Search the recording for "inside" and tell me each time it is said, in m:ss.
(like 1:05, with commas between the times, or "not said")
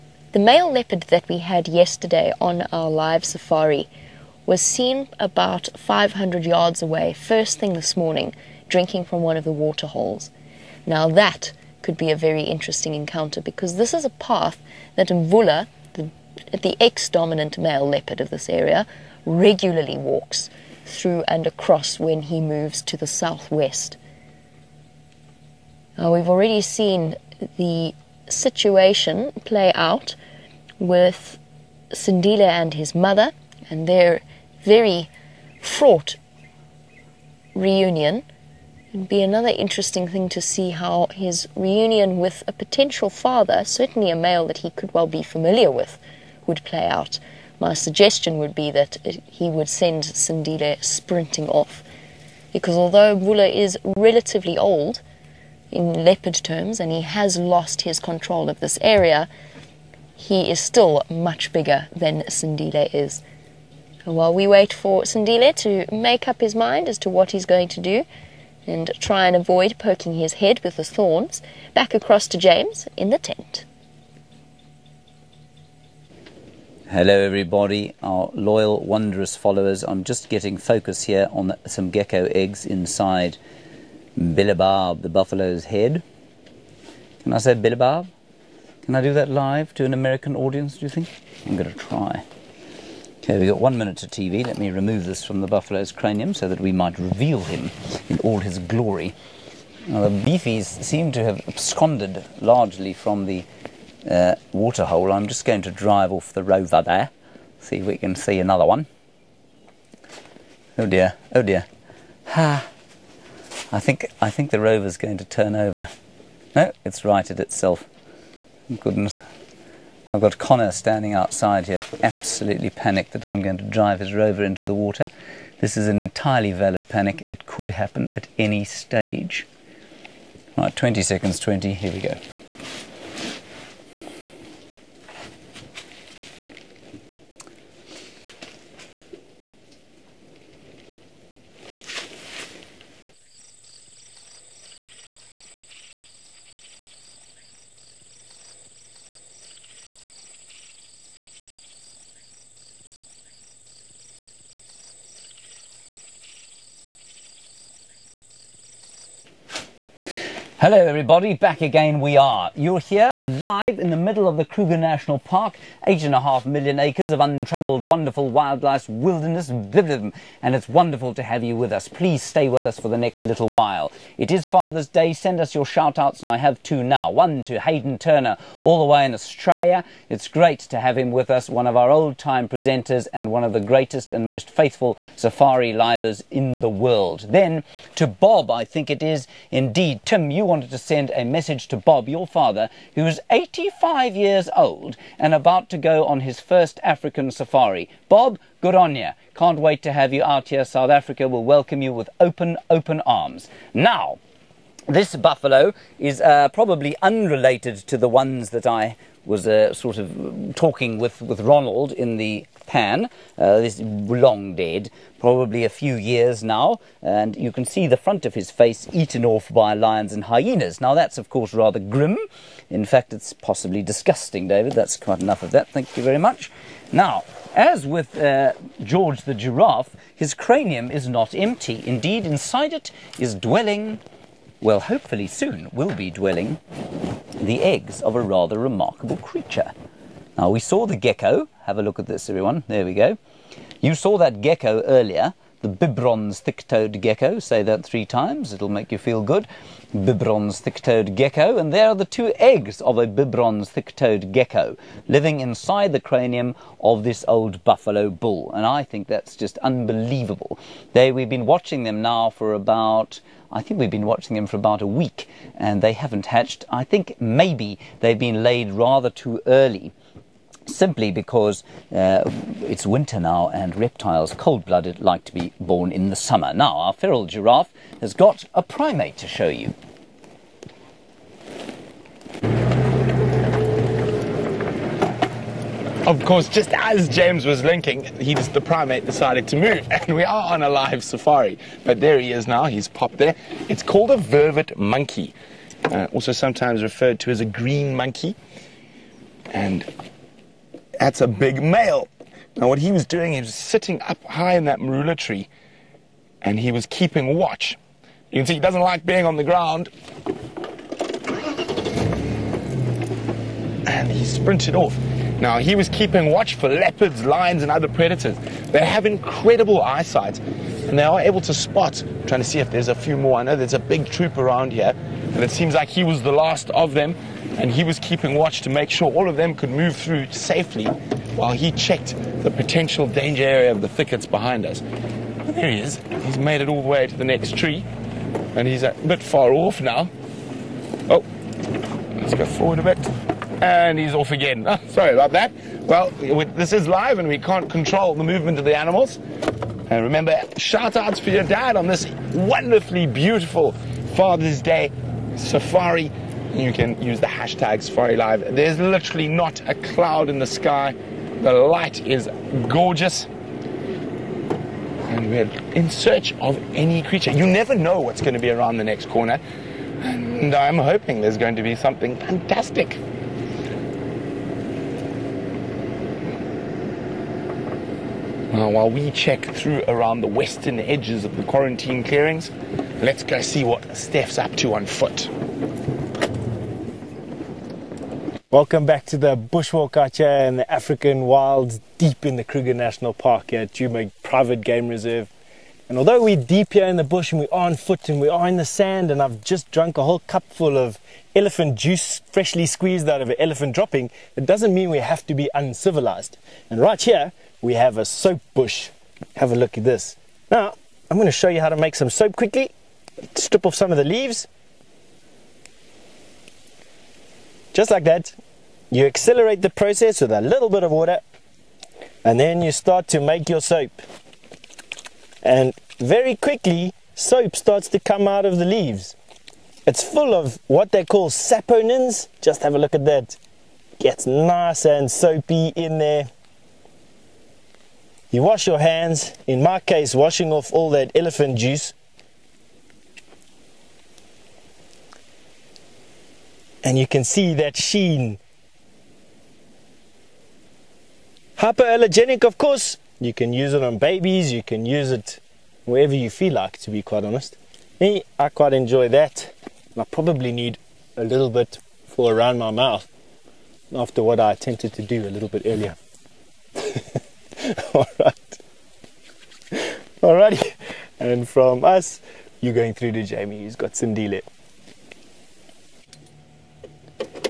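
1:22, 3:52, 4:15.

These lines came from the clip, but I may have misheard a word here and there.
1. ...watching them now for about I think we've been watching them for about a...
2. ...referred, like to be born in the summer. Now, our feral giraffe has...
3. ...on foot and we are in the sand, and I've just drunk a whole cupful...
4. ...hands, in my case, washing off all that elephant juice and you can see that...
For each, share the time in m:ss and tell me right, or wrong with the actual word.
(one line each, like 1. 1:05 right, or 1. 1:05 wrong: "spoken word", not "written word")
1. 4:21 right
2. 4:34 wrong: "blooded", not "referred"
3. 6:37 right
4. 7:18 right.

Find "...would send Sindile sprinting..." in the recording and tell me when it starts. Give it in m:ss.
0:49.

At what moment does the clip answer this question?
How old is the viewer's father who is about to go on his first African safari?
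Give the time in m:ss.
3:13.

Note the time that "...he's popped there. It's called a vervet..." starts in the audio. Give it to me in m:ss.
4:52.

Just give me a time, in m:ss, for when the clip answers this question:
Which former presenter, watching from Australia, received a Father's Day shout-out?
2:57.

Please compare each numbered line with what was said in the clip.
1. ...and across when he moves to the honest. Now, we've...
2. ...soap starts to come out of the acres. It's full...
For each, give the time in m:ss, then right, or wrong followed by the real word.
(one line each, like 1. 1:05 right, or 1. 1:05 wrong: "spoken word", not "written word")
1. 0:21 wrong: "southwest", not "honest"
2. 7:07 wrong: "leaves", not "acres".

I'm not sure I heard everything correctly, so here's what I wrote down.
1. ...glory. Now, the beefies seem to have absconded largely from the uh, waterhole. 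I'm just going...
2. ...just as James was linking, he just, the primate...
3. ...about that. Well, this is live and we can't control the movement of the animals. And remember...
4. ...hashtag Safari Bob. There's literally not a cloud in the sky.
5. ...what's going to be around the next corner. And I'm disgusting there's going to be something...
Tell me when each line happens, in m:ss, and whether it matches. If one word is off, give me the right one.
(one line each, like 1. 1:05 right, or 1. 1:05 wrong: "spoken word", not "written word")
1. 1:38 right
2. 4:46 right
3. 5:45 right
4. 5:57 wrong: "Live", not "Bob"
5. 6:07 wrong: "hoping", not "disgusting".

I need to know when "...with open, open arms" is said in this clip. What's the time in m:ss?
3:21.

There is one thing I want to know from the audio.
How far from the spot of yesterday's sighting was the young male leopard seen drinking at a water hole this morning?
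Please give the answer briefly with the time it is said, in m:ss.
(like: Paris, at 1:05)
500 yards, at 0:05.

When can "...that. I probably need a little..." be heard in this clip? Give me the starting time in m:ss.
7:39.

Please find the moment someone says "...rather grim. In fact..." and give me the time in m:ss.
3:41.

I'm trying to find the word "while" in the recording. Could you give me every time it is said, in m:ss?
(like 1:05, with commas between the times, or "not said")
1:04, 2:53, 5:31, 6:18.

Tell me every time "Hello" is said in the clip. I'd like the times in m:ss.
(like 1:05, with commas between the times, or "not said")
1:16, 2:40.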